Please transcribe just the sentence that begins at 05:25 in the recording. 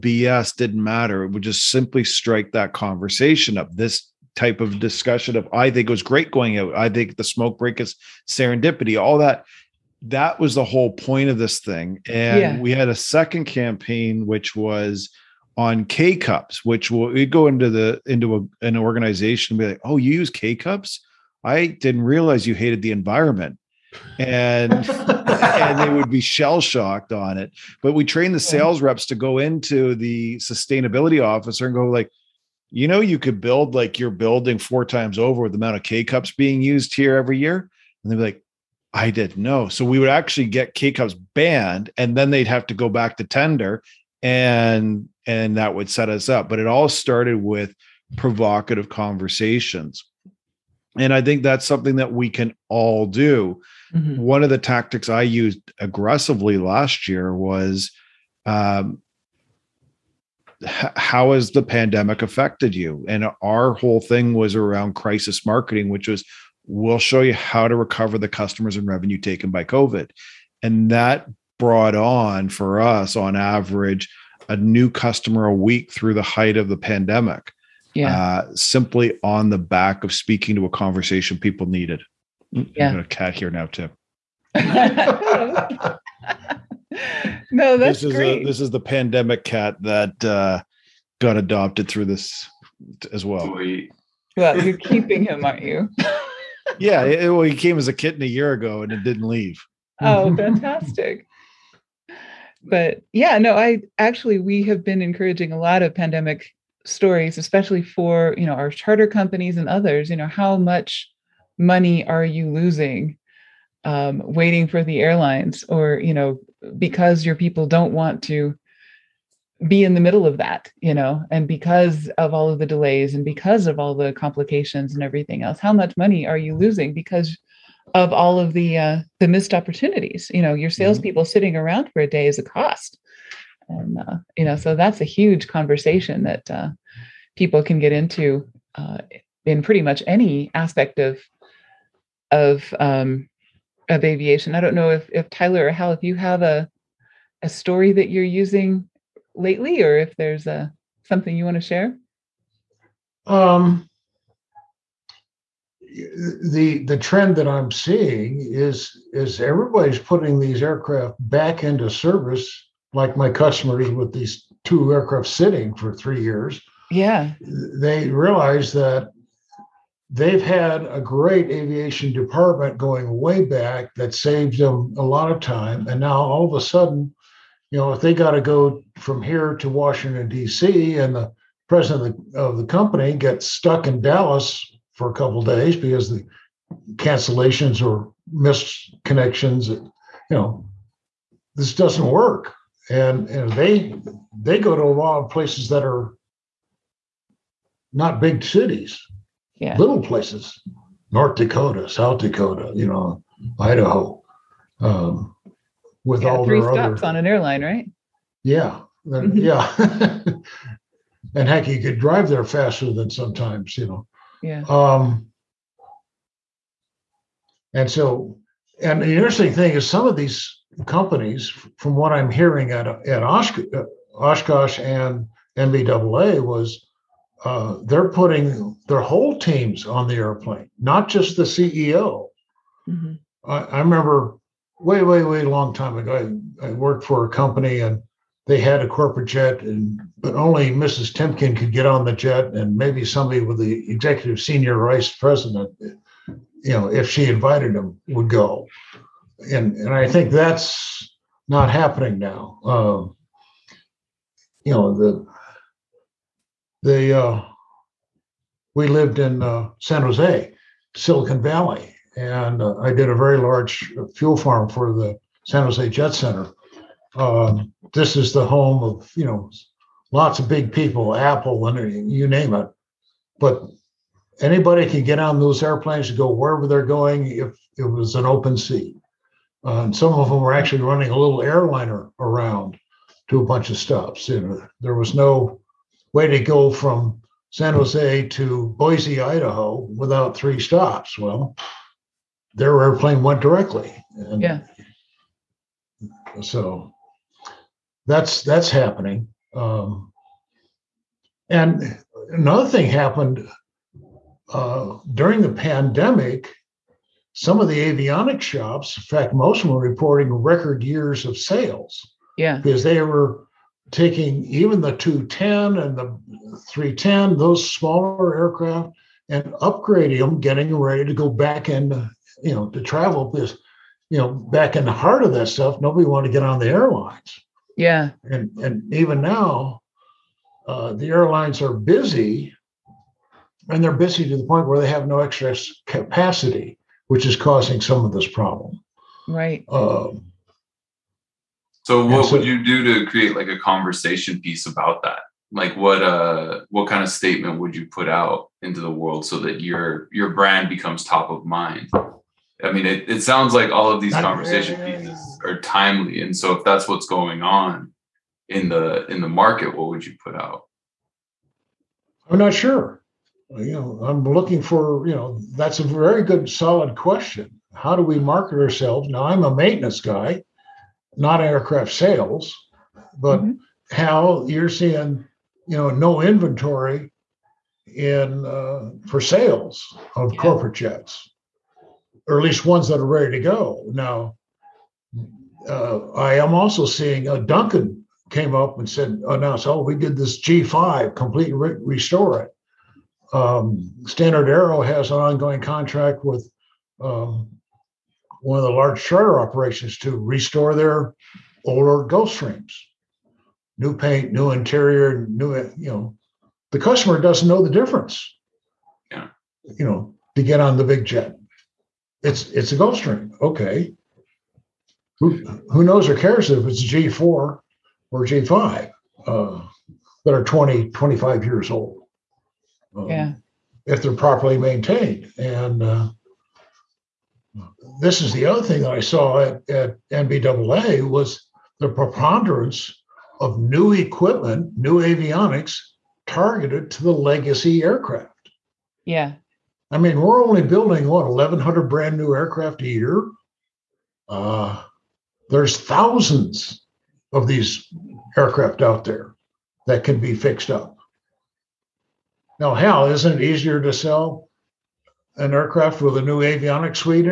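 Nobody wanted to get on the airlines.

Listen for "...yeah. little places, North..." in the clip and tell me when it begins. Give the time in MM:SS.
03:19.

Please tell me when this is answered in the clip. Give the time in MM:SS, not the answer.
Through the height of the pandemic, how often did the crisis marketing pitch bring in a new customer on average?
01:15.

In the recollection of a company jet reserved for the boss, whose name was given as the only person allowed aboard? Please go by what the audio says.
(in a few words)
Mrs. Timken.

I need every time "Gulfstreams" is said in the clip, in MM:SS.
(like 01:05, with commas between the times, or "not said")
06:42, 06:52.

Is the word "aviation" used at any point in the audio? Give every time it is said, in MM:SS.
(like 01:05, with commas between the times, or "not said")
02:24, 02:51.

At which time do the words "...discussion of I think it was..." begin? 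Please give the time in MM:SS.
00:04.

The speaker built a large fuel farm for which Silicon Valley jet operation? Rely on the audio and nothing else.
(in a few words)
San Jose Jet Center.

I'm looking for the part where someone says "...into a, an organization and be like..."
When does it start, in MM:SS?
00:18.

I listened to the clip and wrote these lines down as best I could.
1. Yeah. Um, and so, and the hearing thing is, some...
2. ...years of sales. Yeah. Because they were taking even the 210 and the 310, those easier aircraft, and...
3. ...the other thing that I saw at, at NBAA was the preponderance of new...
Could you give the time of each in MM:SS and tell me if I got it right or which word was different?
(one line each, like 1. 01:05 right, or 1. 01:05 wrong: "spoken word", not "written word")
1. 03:34 wrong: "interesting", not "hearing"
2. 05:10 wrong: "smaller", not "easier"
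3. 07:08 right.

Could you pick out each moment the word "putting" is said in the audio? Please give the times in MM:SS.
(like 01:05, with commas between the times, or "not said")
02:39, 03:48.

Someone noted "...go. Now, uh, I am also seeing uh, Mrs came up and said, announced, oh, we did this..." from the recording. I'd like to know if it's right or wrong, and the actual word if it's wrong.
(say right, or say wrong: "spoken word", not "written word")
wrong: "Duncan", not "Mrs".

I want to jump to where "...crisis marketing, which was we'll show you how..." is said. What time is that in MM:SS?
01:04.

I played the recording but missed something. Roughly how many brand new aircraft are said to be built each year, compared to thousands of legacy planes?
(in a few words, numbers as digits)
1,100.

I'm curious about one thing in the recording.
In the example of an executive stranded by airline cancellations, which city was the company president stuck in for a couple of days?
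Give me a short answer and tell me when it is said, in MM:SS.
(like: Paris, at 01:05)
Dallas, at 03:03.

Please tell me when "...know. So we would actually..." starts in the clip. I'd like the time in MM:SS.
00:39.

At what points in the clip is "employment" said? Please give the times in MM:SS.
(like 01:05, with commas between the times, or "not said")
not said.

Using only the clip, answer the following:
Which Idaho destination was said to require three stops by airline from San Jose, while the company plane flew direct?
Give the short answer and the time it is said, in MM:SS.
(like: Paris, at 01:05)
Boise, at 04:48.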